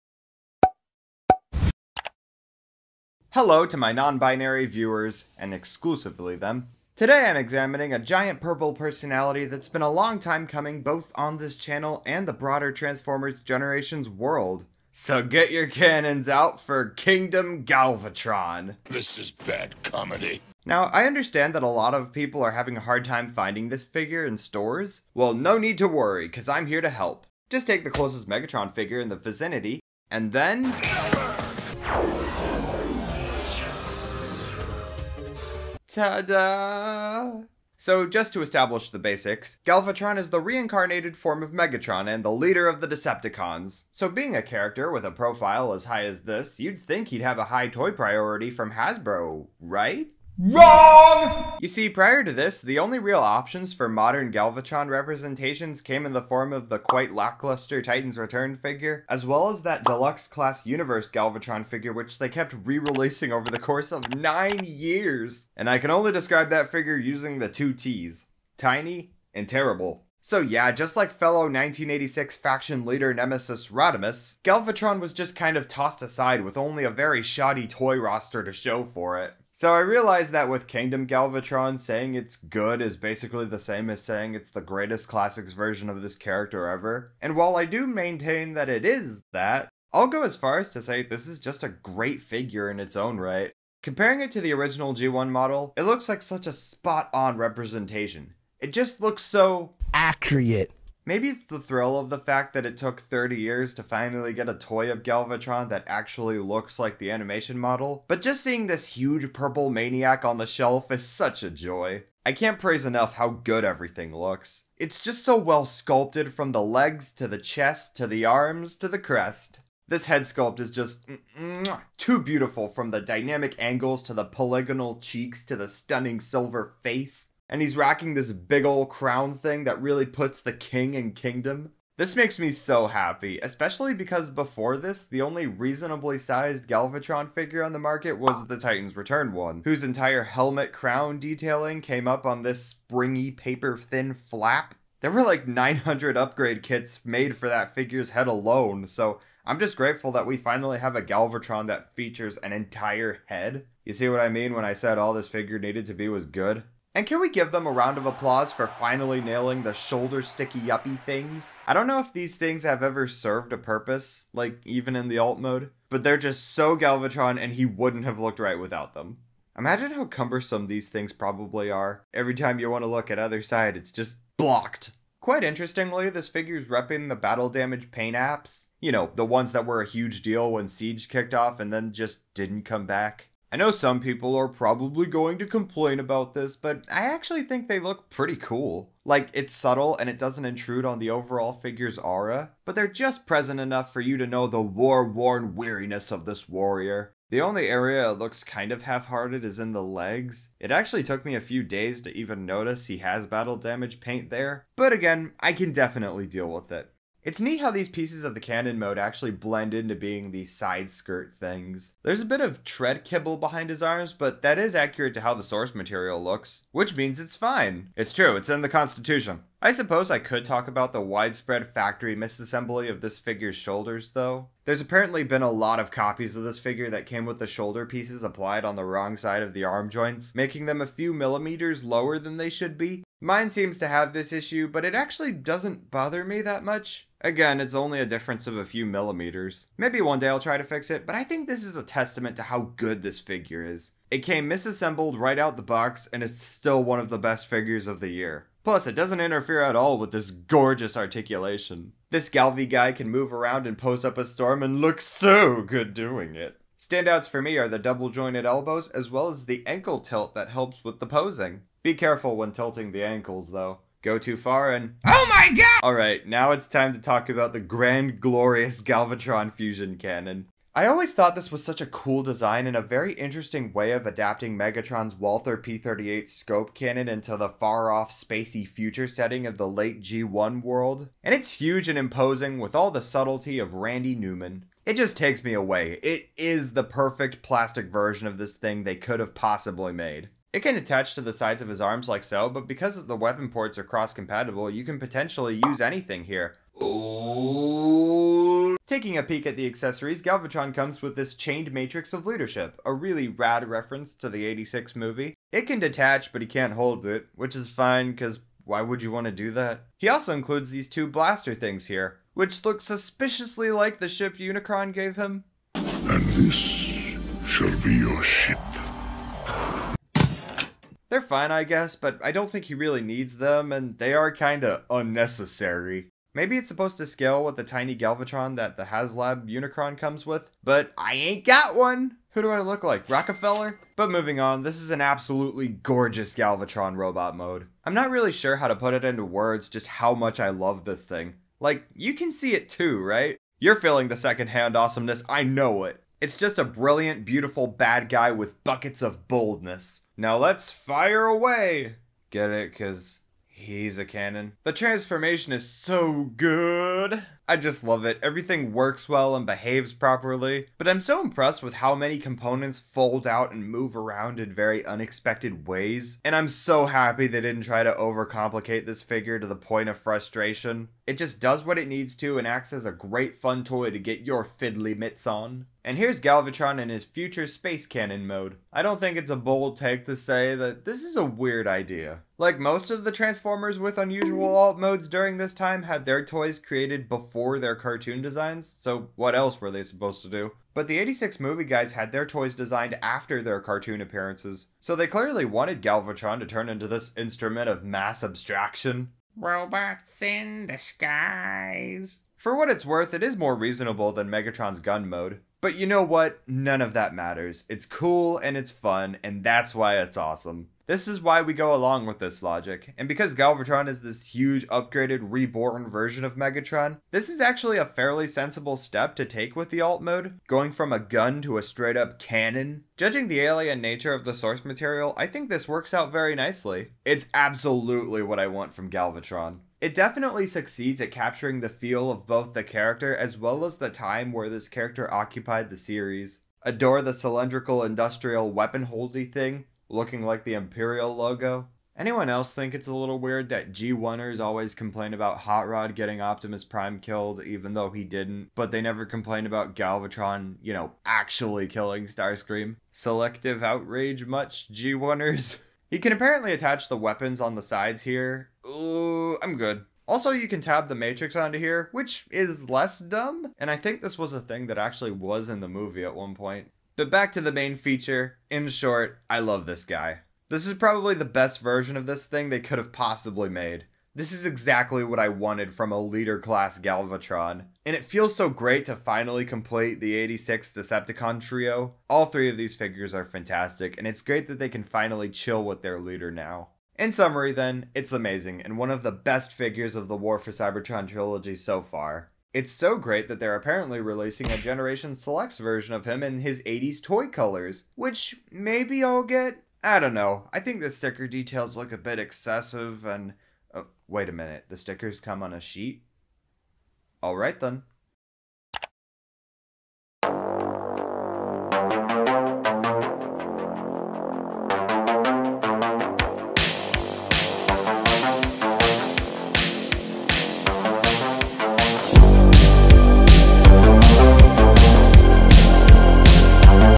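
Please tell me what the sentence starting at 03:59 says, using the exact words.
Maybe one day I'll try to fix it, but I think this is a testament to how good this figure is.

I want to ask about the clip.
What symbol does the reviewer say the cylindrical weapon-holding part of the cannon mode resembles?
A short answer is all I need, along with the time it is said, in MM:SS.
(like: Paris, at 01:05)
Imperial logo, at 07:20.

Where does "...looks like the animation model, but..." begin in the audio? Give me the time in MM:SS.
01:46.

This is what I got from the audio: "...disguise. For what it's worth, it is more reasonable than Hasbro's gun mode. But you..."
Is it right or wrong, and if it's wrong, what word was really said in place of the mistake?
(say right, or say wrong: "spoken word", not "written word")
wrong: "Megatron", not "Hasbro".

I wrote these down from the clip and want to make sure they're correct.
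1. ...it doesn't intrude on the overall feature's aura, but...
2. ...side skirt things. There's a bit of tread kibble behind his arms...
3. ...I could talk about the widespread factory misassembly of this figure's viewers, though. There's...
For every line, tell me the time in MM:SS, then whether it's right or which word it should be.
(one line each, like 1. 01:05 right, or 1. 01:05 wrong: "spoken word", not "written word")
1. 03:10 wrong: "figure", not "feature"
2. 03:30 right
3. 03:40 wrong: "shoulders", not "viewers".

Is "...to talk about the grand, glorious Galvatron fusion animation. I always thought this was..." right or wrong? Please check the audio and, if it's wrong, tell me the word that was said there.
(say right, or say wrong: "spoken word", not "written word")
wrong: "cannon", not "animation".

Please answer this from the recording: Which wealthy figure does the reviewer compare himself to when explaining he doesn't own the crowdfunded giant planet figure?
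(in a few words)
Rockefeller.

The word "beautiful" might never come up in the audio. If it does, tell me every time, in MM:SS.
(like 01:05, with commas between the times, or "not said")
02:02, 05:47.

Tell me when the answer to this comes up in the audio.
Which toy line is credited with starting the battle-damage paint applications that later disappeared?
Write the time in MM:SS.
03:00.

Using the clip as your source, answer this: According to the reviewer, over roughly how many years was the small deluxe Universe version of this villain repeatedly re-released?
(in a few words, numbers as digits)
9.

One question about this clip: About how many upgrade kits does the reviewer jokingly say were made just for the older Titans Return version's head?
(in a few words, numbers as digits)
900.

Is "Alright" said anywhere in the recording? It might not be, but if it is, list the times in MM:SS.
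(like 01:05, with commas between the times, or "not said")
04:25, 08:27.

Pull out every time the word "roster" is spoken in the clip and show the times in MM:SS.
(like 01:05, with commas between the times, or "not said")
01:17.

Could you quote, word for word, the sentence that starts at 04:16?
Standouts for me are the double jointed elbows as well as the ankle tilt that helps with the posing.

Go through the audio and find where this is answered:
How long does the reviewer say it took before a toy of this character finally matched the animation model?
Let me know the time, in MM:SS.
01:43.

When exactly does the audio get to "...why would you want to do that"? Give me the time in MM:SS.
05:08.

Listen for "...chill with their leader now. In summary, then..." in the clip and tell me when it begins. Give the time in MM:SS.
08:05.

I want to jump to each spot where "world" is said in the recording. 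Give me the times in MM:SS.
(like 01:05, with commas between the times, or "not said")
00:14, 04:40.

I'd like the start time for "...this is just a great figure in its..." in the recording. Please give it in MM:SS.
01:31.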